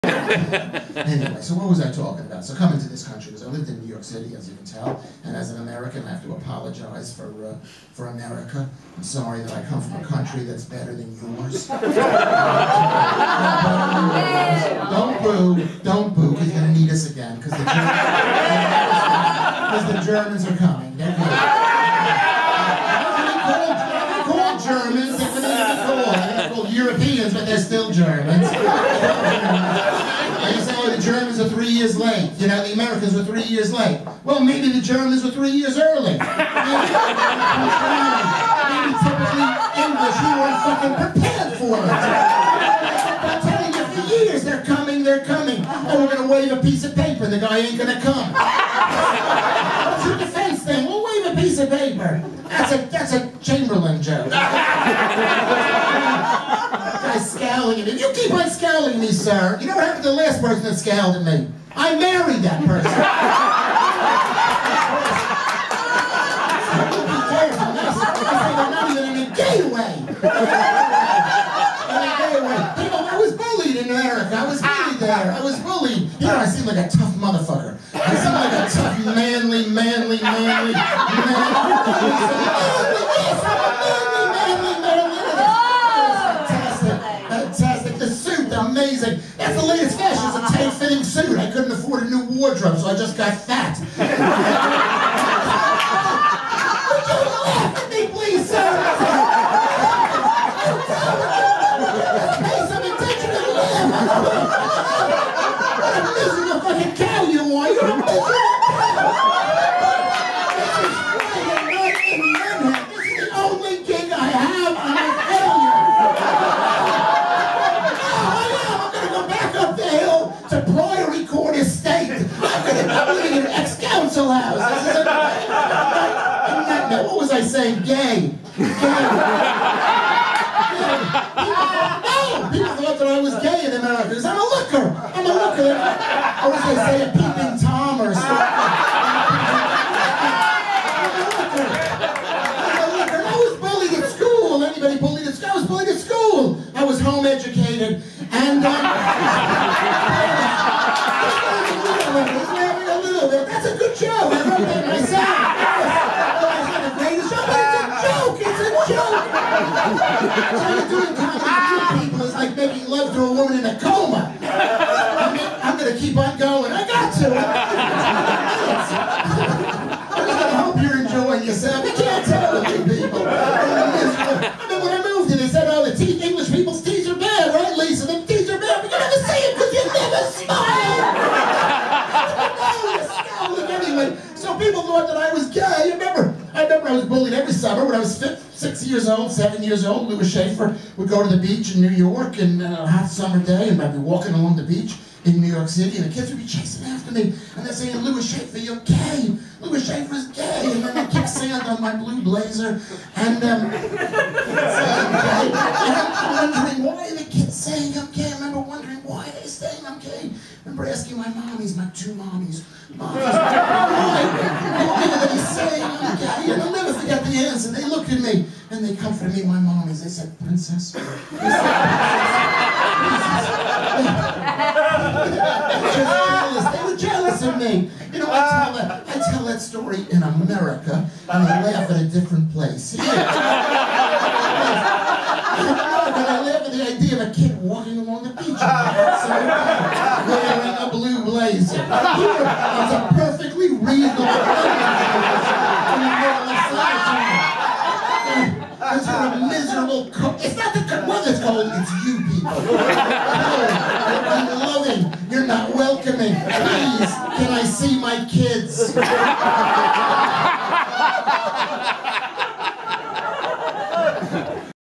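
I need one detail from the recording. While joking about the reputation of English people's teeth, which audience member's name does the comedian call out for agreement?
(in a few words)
Lisa.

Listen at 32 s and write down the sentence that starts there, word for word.
You know, the Americans were three years late.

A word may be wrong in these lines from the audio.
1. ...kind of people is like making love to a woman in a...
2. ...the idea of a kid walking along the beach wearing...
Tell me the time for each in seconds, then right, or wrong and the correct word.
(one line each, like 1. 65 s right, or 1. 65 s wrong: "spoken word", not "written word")
1. 161 s right
2. 236 s right.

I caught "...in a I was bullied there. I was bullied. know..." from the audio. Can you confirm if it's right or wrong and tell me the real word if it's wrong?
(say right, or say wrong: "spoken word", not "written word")
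right.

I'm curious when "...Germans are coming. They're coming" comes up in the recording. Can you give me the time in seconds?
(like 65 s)
20 s.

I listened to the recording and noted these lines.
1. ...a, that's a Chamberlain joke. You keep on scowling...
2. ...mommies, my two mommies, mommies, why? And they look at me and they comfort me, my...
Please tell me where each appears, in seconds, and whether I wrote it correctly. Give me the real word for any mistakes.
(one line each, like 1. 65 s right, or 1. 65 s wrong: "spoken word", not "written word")
1. 52 s right
2. 211 s right.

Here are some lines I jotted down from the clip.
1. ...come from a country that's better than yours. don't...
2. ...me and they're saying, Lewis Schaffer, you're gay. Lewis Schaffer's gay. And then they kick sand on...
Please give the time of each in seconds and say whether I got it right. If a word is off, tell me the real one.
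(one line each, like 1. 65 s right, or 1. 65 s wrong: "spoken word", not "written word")
1. 9 s right
2. 197 s right.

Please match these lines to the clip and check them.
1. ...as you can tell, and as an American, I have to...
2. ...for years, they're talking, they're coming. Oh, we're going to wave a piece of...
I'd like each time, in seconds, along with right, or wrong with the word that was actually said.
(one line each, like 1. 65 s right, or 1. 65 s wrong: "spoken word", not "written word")
1. 4 s right
2. 44 s wrong: "coming", not "talking".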